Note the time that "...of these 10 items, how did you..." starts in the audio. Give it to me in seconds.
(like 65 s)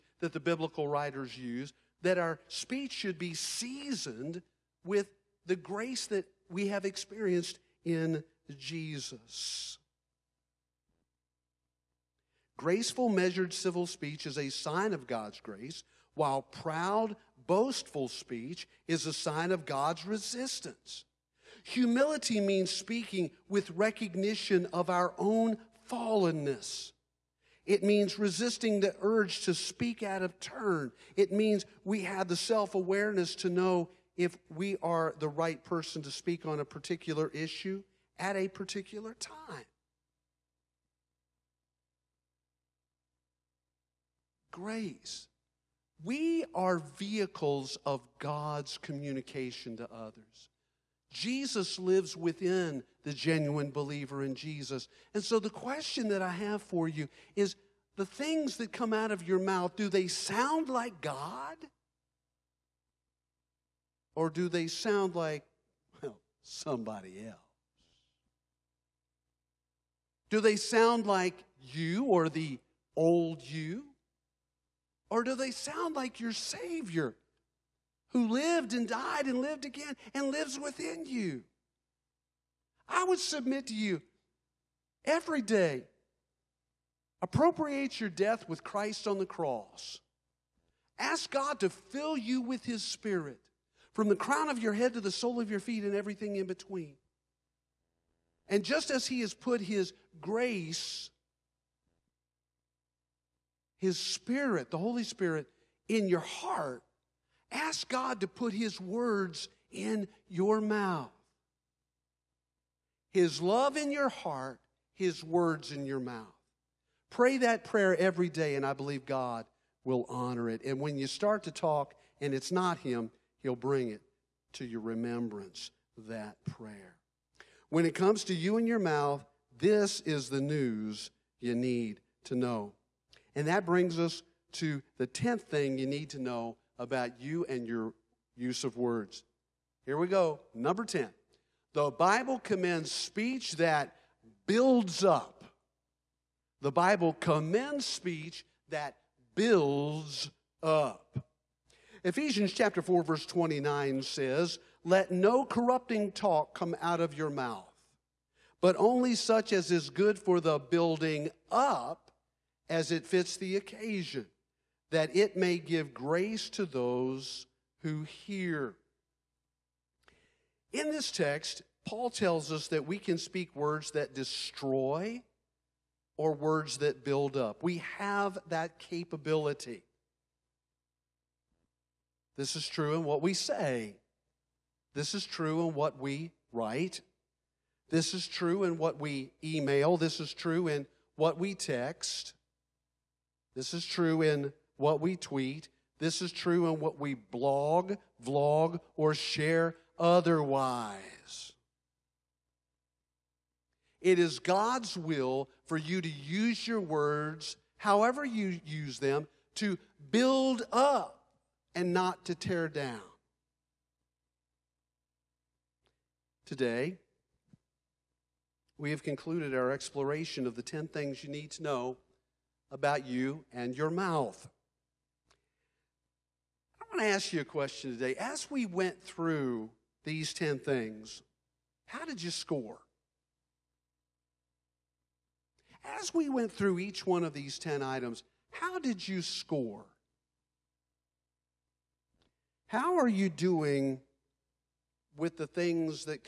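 237 s.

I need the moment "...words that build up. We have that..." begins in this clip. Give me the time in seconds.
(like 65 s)
176 s.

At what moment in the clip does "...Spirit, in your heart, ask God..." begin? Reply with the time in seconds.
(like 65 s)
105 s.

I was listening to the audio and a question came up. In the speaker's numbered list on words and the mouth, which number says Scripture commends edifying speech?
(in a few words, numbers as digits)
10.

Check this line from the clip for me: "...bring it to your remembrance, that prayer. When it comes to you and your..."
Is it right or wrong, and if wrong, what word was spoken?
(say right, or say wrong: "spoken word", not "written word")
right.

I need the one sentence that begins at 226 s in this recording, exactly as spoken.
I want to ask you a question today.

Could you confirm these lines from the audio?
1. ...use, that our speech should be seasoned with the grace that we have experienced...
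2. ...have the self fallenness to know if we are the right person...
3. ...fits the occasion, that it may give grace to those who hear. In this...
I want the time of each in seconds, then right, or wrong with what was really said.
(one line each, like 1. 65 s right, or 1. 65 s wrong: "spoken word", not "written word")
1. 1 s right
2. 32 s wrong: "awareness", not "fallenness"
3. 163 s right.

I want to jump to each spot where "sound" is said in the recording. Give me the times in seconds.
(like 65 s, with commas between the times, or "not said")
60 s, 64 s, 70 s, 75 s.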